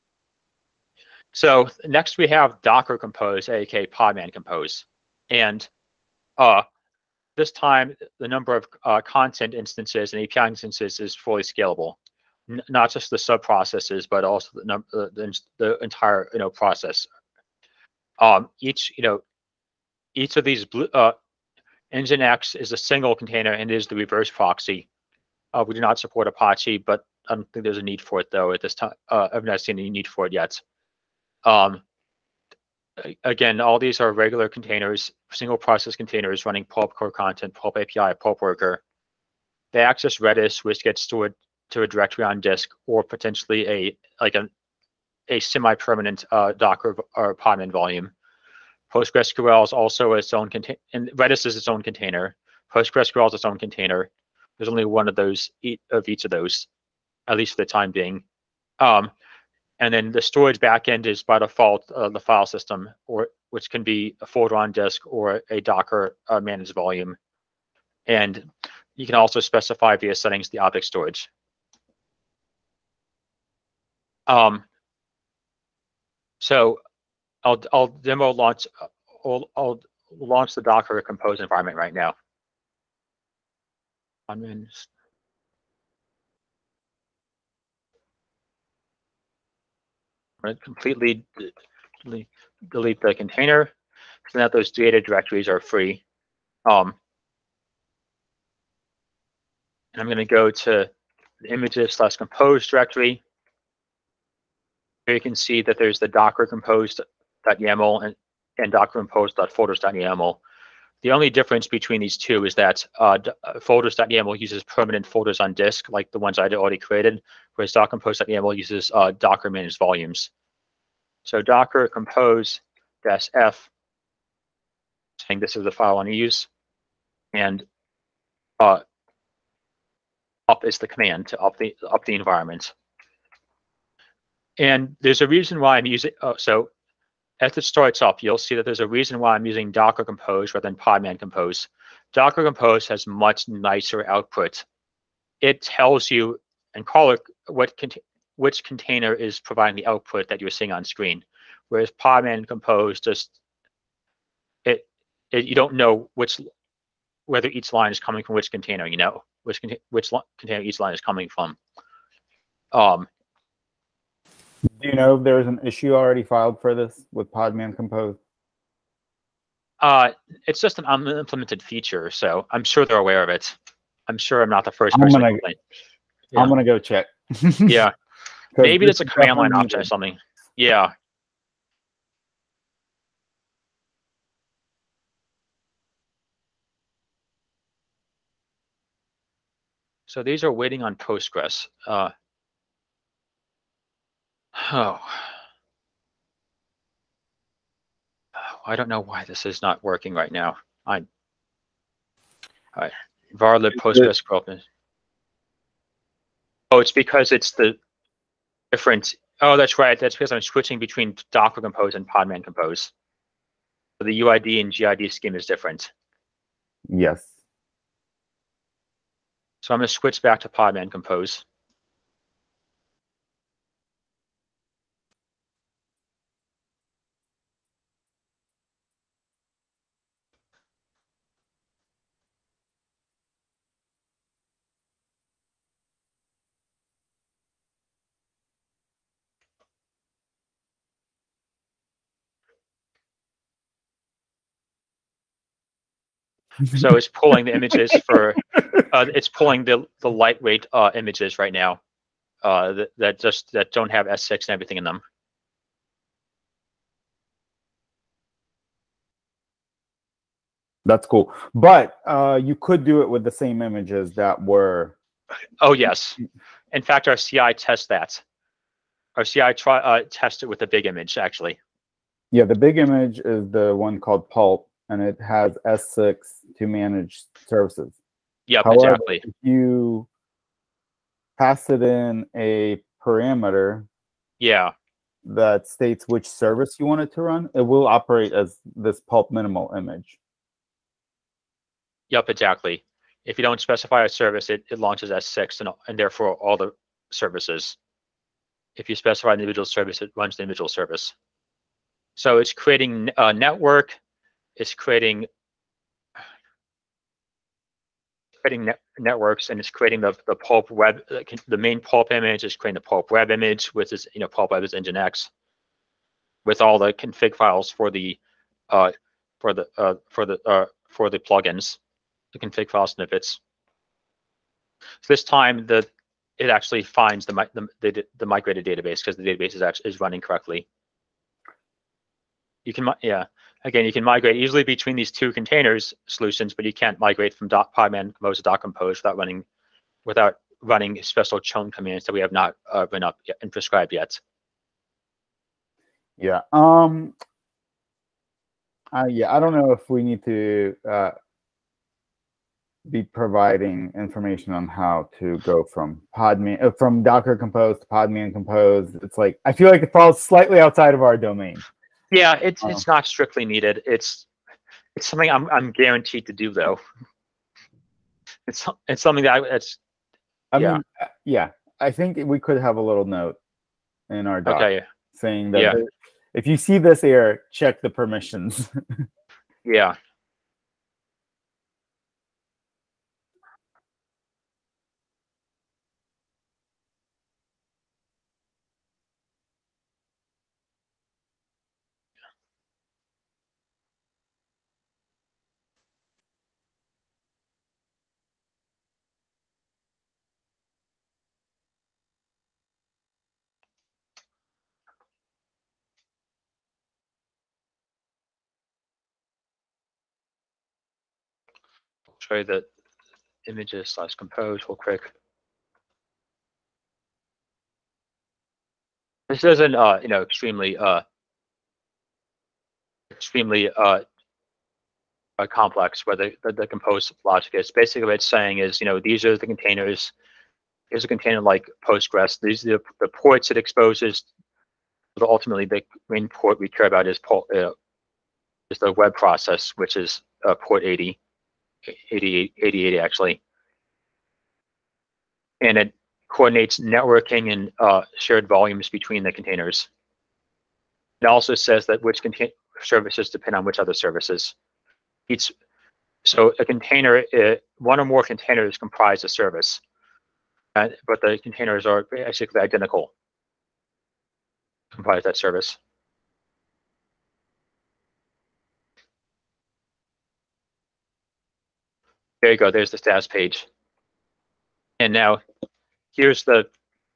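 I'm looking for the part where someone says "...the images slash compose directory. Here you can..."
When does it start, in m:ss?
1:41.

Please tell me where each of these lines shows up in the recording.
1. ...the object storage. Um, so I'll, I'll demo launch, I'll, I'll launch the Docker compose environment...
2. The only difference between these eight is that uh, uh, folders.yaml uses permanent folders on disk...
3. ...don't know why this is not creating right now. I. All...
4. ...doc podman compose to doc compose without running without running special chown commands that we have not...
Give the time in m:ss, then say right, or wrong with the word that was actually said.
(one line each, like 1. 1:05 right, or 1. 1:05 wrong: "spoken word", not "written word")
1. 1:10 right
2. 1:51 wrong: "two", not "eight"
3. 3:18 wrong: "working", not "creating"
4. 5:37 right.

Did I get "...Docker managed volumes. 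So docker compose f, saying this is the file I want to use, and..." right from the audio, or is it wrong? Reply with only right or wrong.
right.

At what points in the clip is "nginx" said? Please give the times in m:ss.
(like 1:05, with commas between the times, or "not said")
0:21, 5:14.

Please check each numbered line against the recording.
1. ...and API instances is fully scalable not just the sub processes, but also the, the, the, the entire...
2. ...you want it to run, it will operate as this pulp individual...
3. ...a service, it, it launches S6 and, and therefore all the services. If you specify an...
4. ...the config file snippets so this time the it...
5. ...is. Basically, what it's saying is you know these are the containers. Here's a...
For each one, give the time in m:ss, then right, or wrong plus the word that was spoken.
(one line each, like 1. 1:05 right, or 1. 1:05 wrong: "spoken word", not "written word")
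1. 0:10 right
2. 4:46 wrong: "minimal", not "individual"
3. 4:54 right
4. 5:22 right
5. 7:07 right.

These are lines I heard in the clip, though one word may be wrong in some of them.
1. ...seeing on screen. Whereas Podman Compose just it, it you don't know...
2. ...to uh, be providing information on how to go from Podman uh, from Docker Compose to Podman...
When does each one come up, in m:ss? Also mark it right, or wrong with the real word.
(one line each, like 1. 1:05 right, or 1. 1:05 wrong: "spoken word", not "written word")
1. 2:30 right
2. 5:50 right.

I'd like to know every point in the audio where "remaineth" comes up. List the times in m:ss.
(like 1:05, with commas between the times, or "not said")
not said.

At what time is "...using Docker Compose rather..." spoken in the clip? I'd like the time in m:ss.
2:19.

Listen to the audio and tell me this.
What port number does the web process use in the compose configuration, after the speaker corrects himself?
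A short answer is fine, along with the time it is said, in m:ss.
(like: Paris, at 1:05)
88, at 7:22.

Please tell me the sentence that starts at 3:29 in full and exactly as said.
That's because I'm switching between Docker Compose and Podman Compose.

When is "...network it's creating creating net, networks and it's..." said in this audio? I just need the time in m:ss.
5:03.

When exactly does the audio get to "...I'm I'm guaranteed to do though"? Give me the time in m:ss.
6:05.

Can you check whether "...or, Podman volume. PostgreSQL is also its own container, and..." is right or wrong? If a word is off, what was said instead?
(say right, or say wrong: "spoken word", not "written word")
right.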